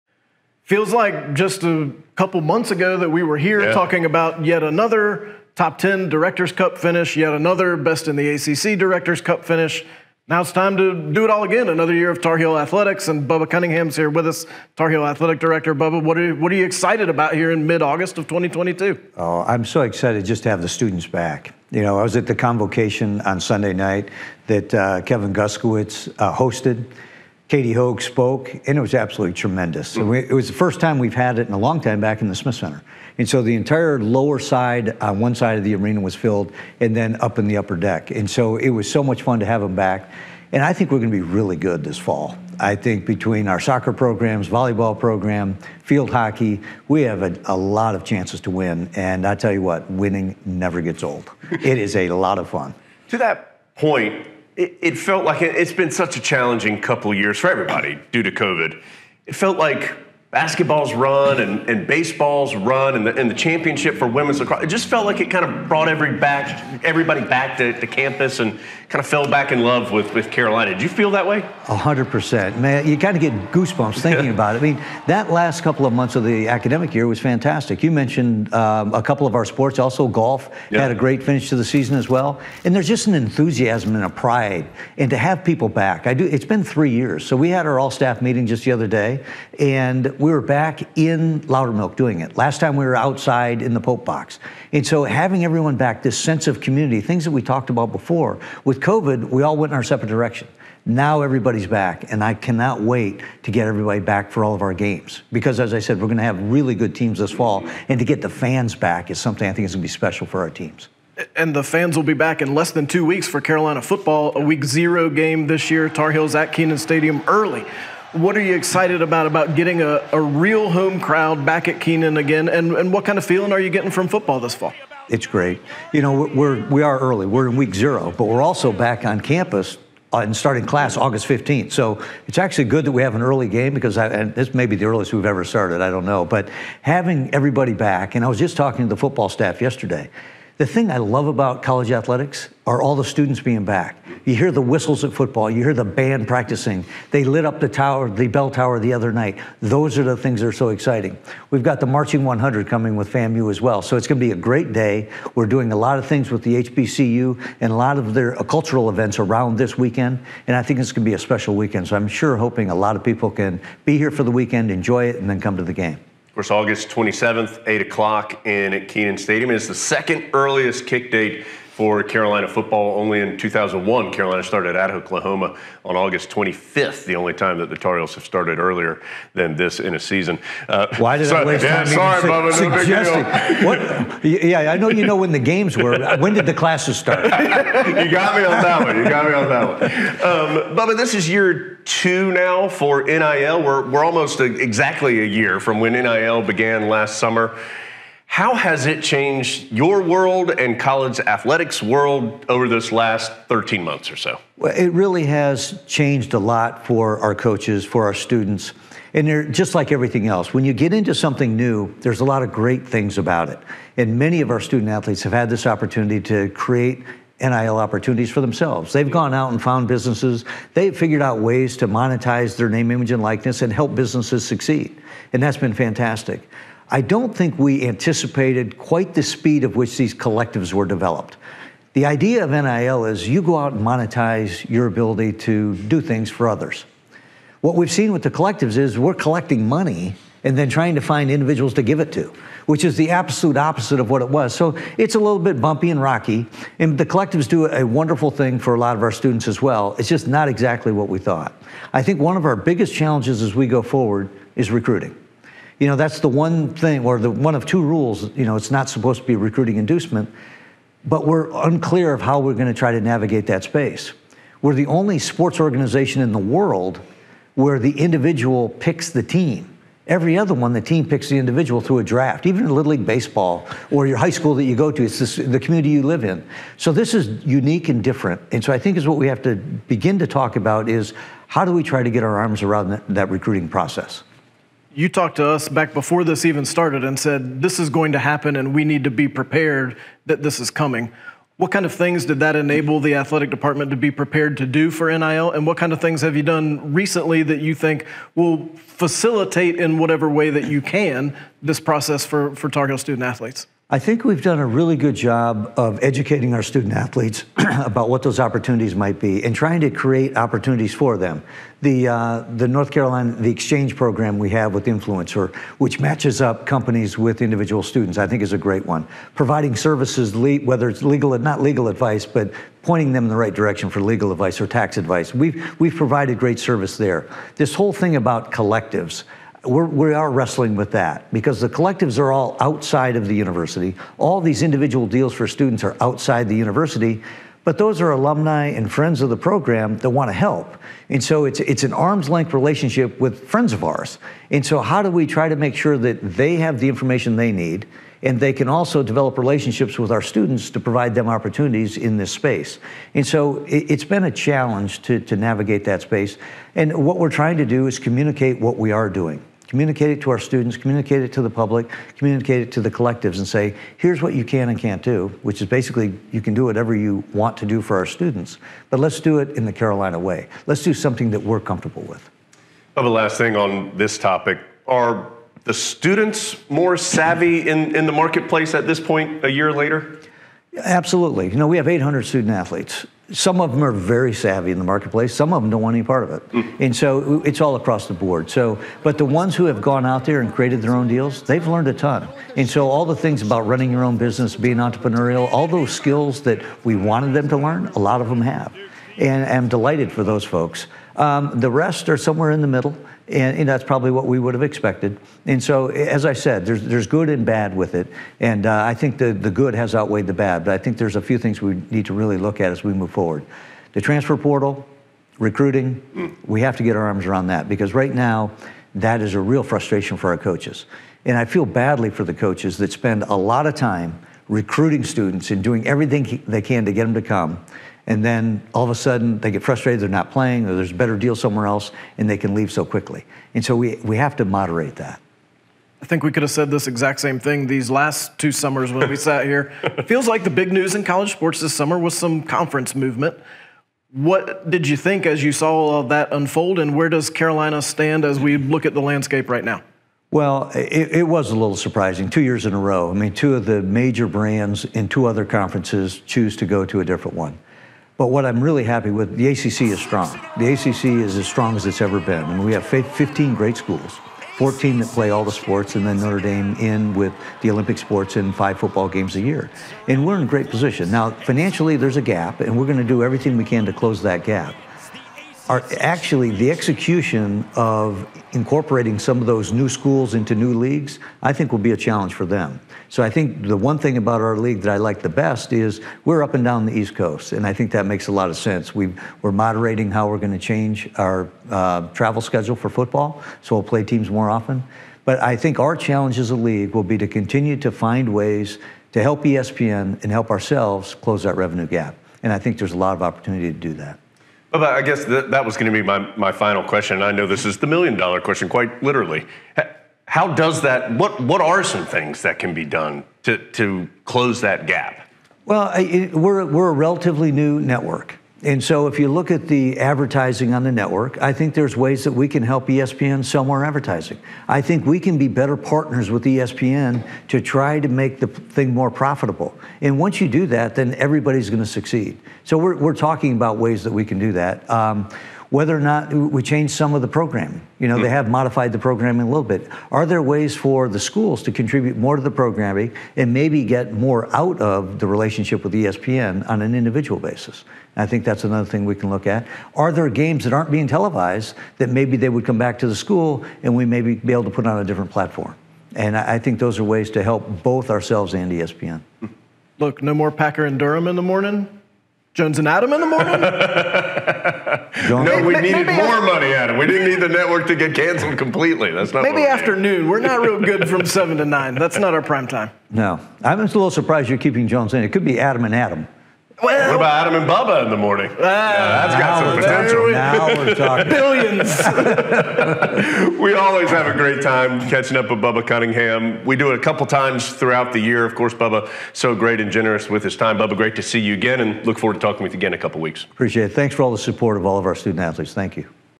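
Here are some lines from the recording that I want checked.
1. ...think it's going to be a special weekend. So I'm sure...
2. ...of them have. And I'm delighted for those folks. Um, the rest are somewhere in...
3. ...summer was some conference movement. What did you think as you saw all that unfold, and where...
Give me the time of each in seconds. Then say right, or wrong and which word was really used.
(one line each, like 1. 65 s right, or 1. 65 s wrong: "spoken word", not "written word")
1. 160 s right
2. 398 s right
3. 441 s right.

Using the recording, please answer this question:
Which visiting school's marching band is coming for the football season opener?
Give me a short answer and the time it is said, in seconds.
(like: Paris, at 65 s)
FAMU, at 153 s.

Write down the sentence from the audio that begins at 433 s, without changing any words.
And so we, we have to moderate that.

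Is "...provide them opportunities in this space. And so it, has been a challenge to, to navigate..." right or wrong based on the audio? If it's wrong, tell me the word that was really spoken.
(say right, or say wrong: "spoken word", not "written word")
right.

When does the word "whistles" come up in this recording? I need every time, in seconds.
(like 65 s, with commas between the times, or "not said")
144 s.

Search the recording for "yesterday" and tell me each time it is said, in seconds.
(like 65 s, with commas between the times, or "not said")
139 s.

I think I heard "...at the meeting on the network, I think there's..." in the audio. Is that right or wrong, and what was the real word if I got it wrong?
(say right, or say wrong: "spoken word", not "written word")
wrong: "advertising", not "meeting".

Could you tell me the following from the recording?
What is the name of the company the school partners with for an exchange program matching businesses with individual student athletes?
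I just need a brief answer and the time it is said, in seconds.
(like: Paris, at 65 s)
Influencer, at 314 s.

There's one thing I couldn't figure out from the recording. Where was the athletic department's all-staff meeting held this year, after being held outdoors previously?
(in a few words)
Loudermilk.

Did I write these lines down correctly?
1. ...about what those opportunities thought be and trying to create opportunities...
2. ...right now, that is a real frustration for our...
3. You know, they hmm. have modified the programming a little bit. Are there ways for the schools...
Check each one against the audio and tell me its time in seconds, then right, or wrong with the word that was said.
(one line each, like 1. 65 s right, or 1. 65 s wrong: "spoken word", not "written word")
1. 307 s wrong: "might", not "thought"
2. 417 s right
3. 537 s right.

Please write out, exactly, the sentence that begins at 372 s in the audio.
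Well, the last thing on this topic are the students more savvy in, in the marketplace at this point a year later?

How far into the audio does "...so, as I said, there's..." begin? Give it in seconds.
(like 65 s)
405 s.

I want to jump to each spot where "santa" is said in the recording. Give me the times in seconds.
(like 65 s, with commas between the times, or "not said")
not said.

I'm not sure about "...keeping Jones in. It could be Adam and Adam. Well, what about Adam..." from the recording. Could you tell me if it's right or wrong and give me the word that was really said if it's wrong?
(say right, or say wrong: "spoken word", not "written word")
right.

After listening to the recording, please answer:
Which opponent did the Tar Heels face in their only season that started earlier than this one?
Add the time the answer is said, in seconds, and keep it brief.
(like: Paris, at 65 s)
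Oklahoma, at 174 s.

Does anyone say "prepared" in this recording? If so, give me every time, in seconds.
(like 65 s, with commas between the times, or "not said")
289 s, 294 s.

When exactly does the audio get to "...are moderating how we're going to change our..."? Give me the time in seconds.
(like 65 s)
489 s.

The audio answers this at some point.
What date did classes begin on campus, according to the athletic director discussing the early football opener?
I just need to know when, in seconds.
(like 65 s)
130 s.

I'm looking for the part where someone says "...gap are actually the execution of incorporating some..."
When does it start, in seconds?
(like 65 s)
474 s.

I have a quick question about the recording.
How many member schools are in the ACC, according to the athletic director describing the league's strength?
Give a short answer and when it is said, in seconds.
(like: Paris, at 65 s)
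15, at 462 s.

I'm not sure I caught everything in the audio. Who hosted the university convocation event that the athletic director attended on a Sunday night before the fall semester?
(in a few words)
Kevin Guskiewicz.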